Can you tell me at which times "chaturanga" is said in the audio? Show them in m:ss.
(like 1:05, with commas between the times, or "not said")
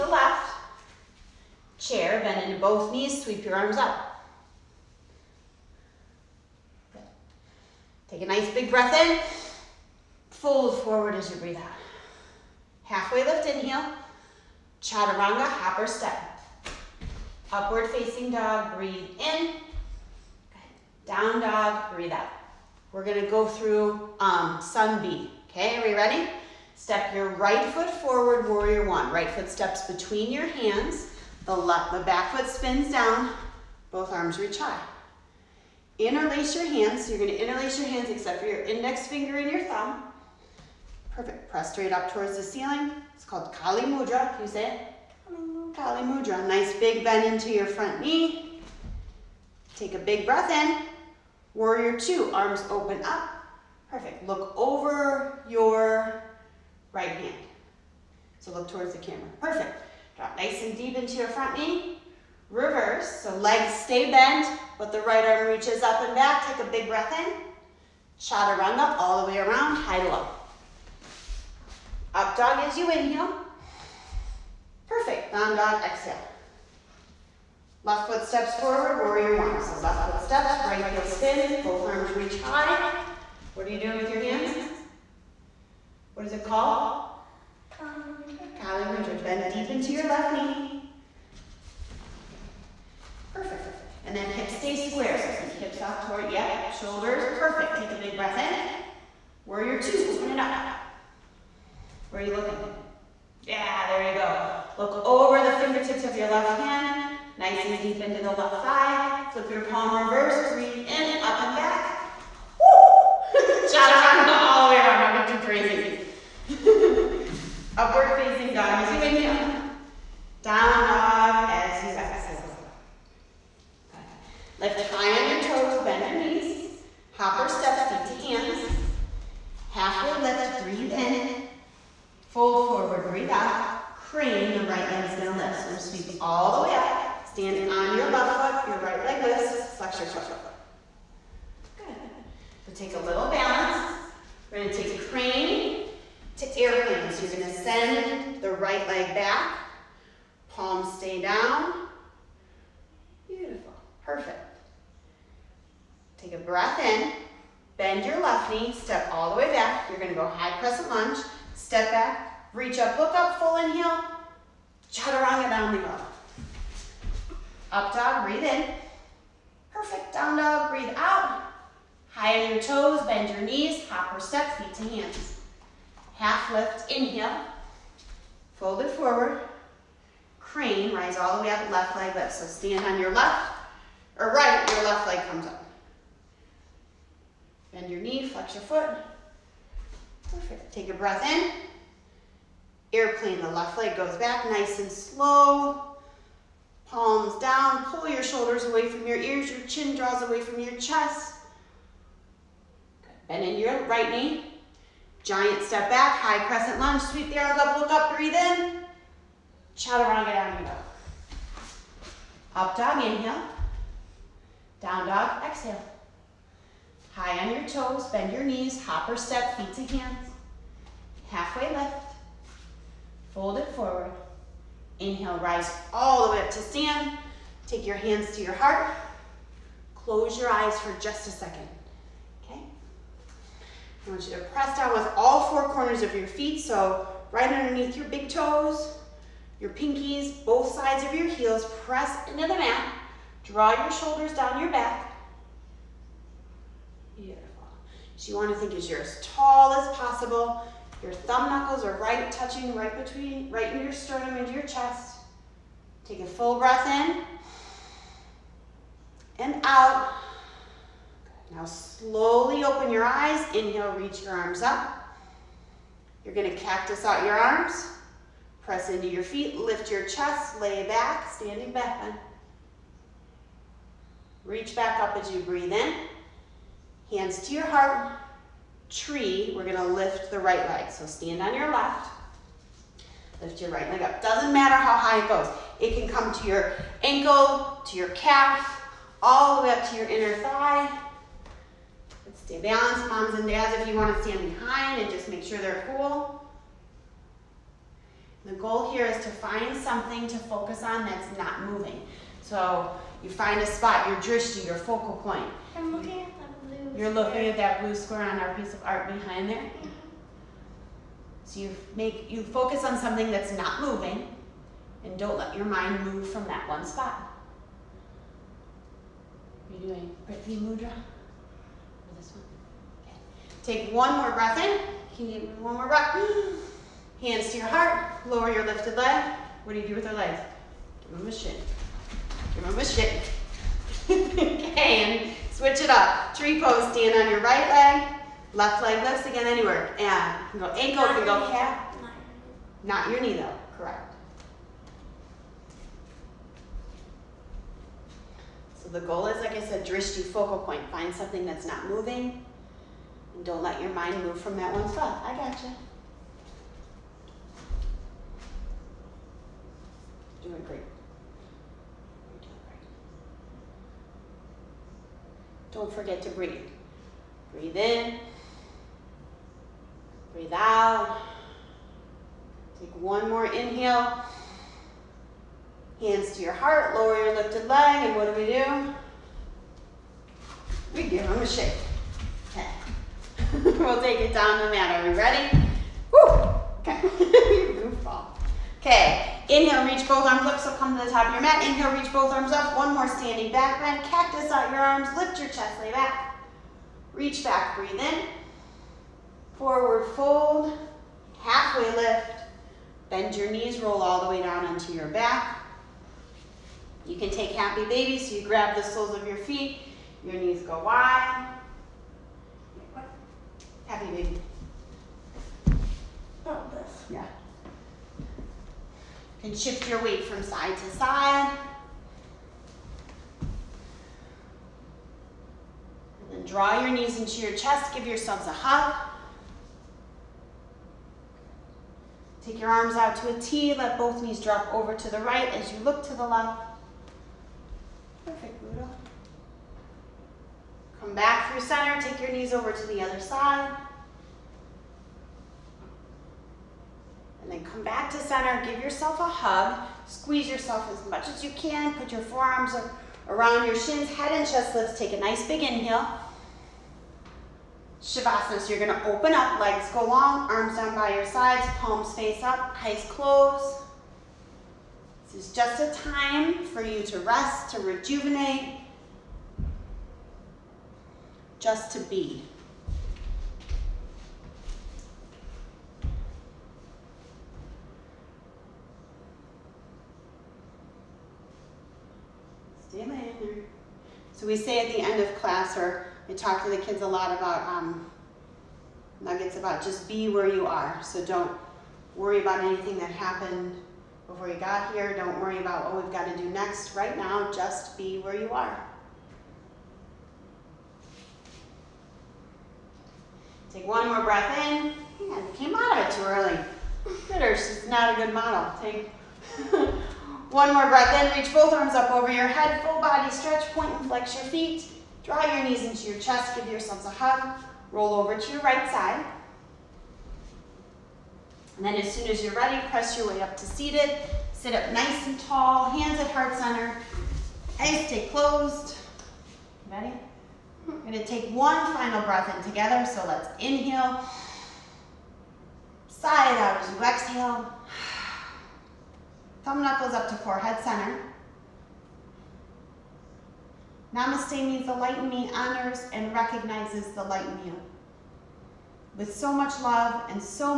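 0:14, 1:08, 1:53, 2:44, 3:29.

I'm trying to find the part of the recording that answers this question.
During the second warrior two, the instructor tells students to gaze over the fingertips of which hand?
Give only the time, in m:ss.
1:46.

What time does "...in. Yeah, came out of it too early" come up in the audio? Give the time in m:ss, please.
8:24.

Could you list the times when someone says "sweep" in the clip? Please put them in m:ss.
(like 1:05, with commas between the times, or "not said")
0:03, 2:15, 3:27.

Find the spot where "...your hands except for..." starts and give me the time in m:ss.
0:37.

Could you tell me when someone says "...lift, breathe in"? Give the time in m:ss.
2:10.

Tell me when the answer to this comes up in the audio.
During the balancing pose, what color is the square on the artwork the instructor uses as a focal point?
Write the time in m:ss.
5:07.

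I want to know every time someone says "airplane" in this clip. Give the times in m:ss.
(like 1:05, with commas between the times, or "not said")
2:26, 3:12.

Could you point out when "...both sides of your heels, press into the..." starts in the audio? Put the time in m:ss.
4:00.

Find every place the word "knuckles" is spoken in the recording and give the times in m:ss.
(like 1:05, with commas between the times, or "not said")
4:11, 8:59.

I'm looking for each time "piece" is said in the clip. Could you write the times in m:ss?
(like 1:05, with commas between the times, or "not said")
5:08.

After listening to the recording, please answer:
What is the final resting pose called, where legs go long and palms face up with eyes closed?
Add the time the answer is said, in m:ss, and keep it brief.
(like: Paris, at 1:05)
Shavasana, at 7:38.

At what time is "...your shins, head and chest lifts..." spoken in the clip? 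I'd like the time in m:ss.
7:33.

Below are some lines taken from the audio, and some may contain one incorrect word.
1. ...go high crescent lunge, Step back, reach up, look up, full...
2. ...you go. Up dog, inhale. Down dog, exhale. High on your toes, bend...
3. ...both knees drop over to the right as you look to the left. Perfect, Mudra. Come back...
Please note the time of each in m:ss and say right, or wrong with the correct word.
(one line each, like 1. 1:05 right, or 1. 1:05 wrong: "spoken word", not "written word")
1. 2:40 right
2. 3:30 right
3. 7:13 wrong: "Buddha", not "Mudra".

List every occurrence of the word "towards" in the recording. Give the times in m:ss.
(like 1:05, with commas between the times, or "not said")
0:42, 0:58, 1:36.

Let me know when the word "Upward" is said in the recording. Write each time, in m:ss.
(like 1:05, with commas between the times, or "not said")
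0:17, 1:57.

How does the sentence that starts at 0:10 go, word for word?
Fold forward as you breathe out.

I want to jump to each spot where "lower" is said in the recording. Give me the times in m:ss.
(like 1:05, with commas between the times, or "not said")
5:28, 6:16.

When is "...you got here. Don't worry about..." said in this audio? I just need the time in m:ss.
8:14.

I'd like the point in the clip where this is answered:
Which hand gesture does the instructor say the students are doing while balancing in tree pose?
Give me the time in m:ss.
5:20.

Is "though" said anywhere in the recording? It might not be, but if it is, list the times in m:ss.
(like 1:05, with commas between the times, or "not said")
5:43.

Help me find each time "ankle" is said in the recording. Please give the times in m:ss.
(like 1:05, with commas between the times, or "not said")
4:47, 5:40.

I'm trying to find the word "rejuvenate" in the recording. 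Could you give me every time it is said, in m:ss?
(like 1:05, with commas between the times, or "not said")
7:47.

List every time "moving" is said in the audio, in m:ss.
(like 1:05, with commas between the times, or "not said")
5:01, 5:13, 5:51.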